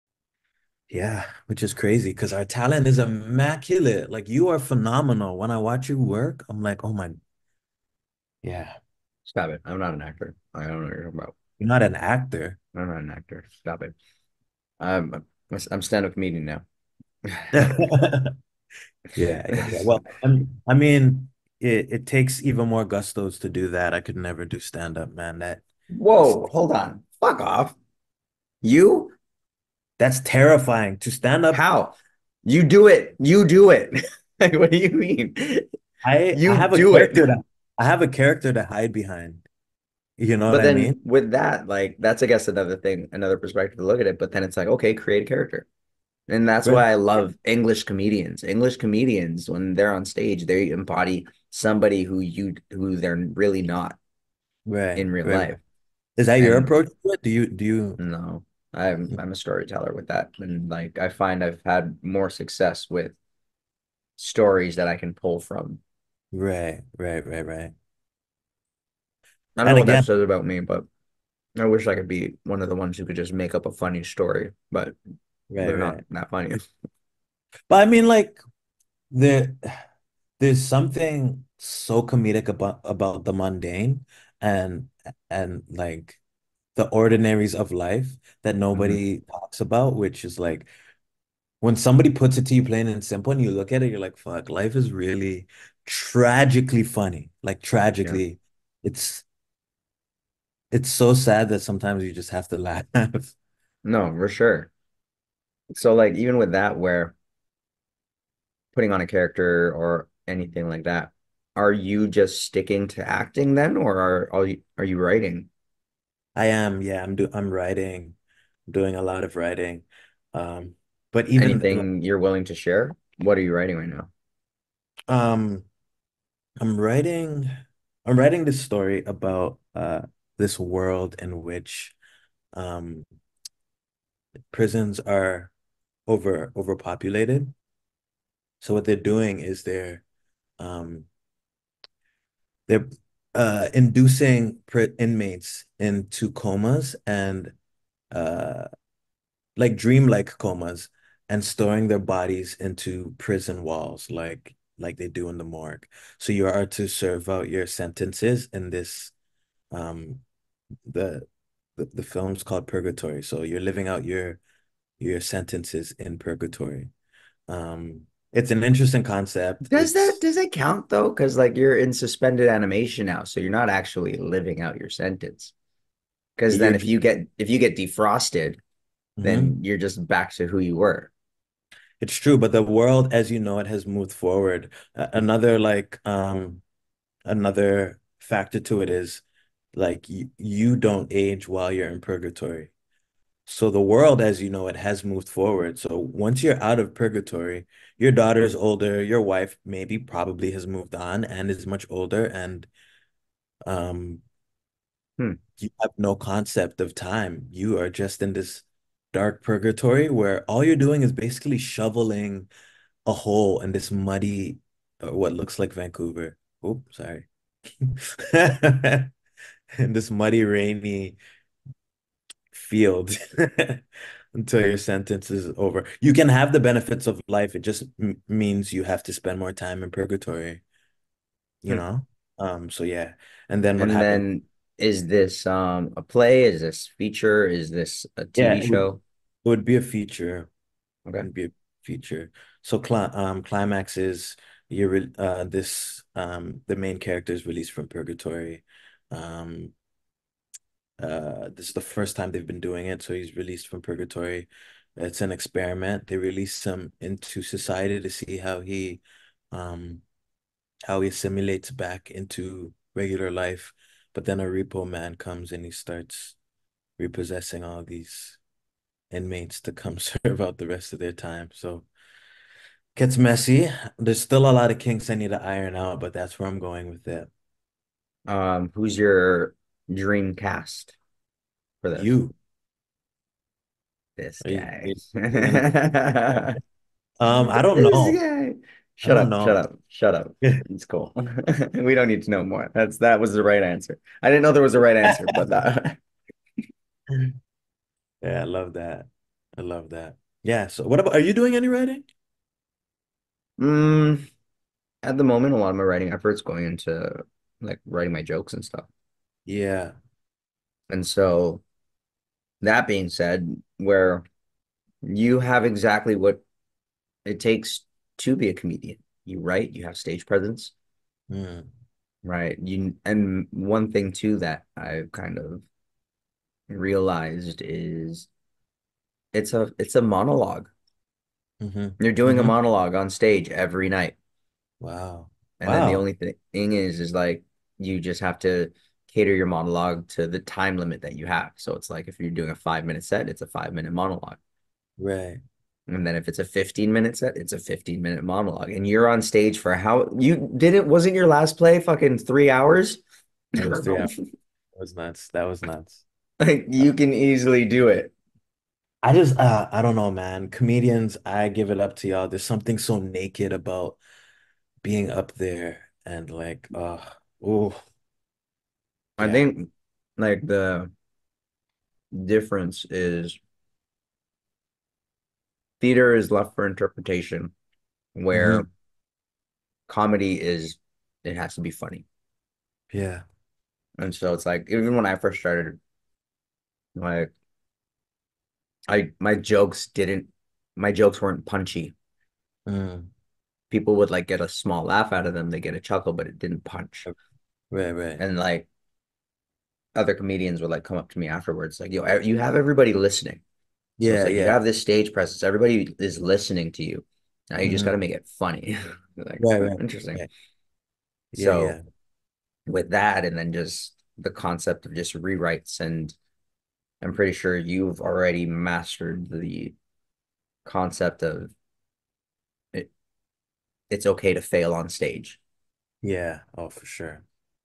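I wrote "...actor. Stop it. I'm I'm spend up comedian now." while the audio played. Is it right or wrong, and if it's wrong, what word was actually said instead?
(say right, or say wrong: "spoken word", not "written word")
wrong: "stand", not "spend".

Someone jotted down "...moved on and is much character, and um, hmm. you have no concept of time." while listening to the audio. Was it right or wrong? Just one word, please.
wrong.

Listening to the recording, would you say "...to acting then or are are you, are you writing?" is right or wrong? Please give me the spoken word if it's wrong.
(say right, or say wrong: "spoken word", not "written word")
right.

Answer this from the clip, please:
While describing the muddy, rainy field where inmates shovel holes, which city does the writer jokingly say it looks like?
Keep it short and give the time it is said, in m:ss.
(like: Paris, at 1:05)
Vancouver, at 3:35.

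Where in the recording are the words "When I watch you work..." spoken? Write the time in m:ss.
0:05.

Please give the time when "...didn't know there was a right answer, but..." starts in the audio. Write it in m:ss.
4:54.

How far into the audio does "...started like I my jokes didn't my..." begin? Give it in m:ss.
6:25.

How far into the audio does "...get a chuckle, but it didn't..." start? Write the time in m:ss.
6:35.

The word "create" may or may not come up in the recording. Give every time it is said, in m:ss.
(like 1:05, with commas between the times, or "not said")
0:44.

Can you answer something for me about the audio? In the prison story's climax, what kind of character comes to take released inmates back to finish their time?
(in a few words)
A repo man.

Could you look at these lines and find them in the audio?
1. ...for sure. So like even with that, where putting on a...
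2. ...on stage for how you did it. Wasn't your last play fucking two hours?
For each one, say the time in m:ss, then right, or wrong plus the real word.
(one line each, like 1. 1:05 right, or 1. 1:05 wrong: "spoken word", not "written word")
1. 1:44 right
2. 5:49 wrong: "three", not "two".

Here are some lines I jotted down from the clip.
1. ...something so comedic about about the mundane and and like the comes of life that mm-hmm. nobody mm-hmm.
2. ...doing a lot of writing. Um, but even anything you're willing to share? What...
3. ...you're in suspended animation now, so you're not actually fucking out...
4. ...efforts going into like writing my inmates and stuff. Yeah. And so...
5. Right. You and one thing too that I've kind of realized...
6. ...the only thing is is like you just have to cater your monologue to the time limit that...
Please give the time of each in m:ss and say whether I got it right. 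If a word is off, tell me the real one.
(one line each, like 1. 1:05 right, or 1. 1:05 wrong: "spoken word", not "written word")
1. 1:20 wrong: "ordinaries", not "comes"
2. 1:58 right
3. 2:51 wrong: "living", not "fucking"
4. 5:06 wrong: "jokes", not "inmates"
5. 5:22 right
6. 5:35 right.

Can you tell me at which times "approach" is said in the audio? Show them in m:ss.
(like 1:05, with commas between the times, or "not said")
0:56.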